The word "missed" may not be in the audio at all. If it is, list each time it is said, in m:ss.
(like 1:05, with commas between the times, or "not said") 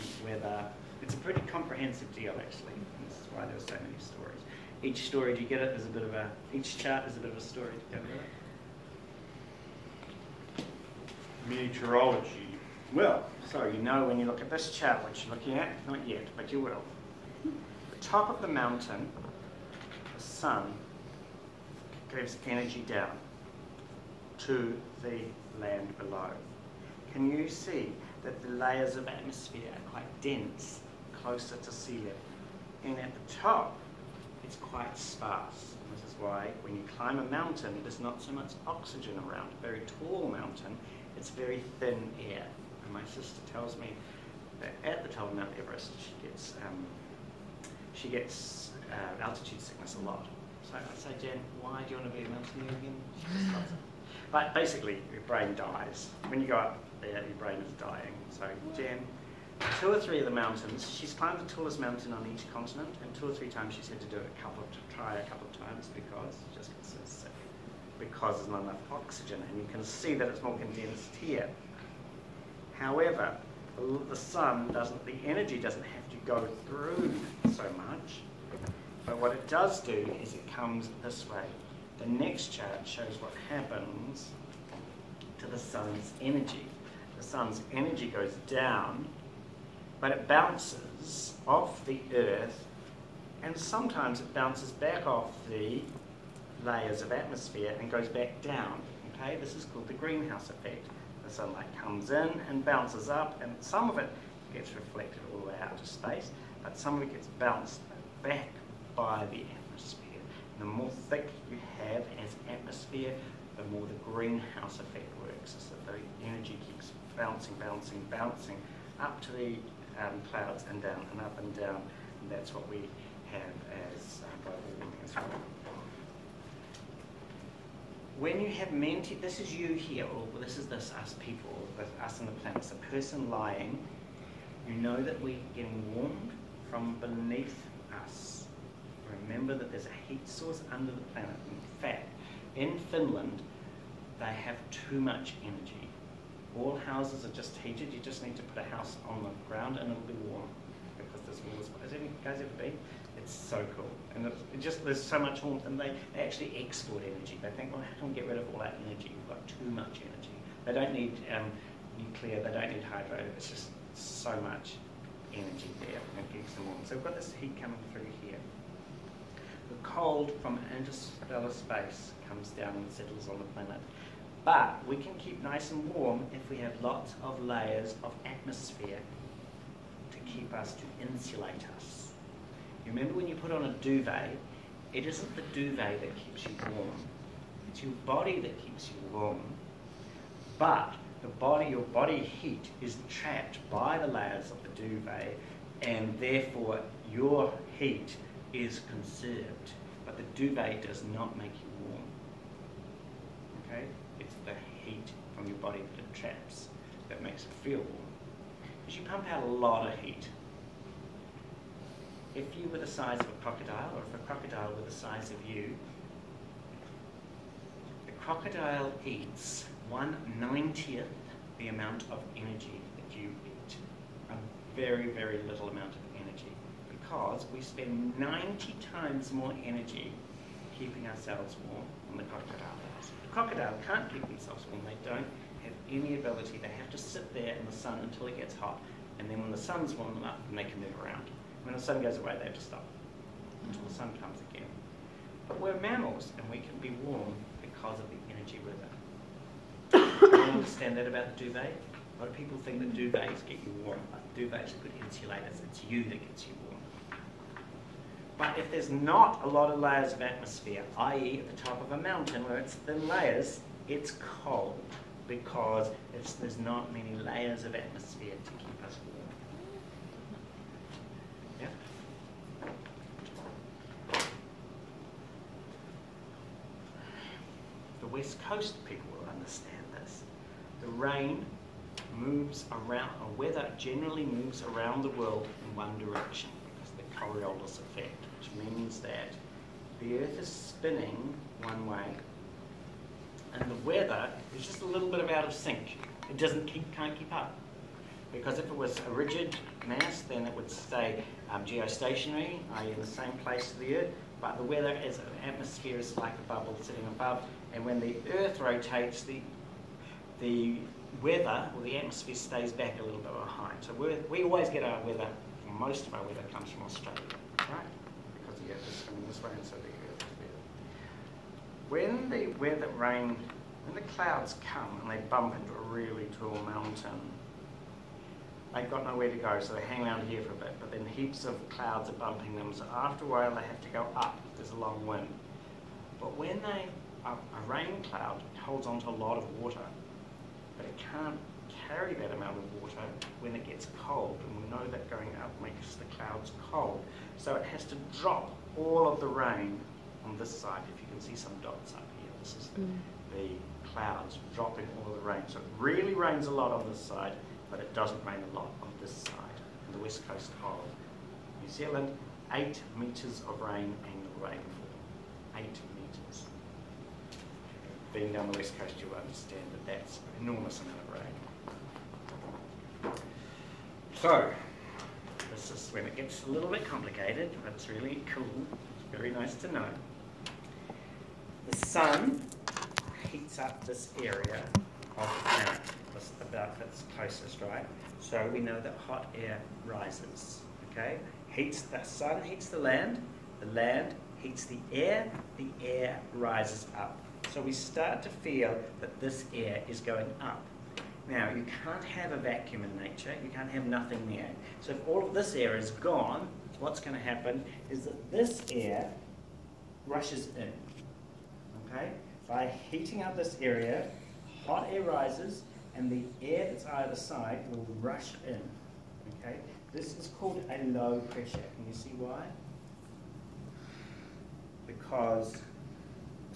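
not said.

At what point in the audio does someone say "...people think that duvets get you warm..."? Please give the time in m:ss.
4:12.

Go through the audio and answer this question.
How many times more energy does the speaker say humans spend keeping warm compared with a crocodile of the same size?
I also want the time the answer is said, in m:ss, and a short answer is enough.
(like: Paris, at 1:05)
90, at 3:48.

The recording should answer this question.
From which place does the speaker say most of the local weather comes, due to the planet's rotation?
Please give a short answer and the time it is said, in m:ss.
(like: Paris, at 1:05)
Australia, at 5:16.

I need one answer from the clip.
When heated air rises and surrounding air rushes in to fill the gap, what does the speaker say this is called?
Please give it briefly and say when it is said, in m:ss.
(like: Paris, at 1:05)
low pressure, at 7:00.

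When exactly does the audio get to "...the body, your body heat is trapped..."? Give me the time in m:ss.
3:11.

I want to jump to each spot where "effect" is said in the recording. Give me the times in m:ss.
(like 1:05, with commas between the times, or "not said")
1:40, 1:54, 4:47.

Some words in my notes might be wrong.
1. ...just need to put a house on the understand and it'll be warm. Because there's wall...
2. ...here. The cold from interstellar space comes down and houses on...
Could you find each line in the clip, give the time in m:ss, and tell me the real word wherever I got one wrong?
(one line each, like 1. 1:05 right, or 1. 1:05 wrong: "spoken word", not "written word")
1. 2:28 wrong: "ground", not "understand"
2. 2:48 wrong: "settles", not "houses".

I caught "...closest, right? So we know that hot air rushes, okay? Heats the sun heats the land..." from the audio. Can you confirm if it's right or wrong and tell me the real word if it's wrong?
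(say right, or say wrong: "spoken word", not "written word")
wrong: "rises", not "rushes".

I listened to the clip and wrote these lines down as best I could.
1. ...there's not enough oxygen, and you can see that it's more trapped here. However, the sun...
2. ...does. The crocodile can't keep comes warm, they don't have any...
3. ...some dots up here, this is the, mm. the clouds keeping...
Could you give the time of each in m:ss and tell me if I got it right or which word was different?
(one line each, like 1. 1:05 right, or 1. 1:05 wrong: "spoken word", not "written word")
1. 1:08 wrong: "condensed", not "trapped"
2. 3:52 wrong: "themselves", not "comes"
3. 5:51 wrong: "dropping", not "keeping".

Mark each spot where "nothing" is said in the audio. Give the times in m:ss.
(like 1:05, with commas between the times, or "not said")
6:43.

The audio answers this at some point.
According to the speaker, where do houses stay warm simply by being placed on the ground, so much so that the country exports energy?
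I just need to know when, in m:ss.
2:22.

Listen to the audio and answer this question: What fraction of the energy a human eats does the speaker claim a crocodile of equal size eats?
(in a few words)
one ninetieth.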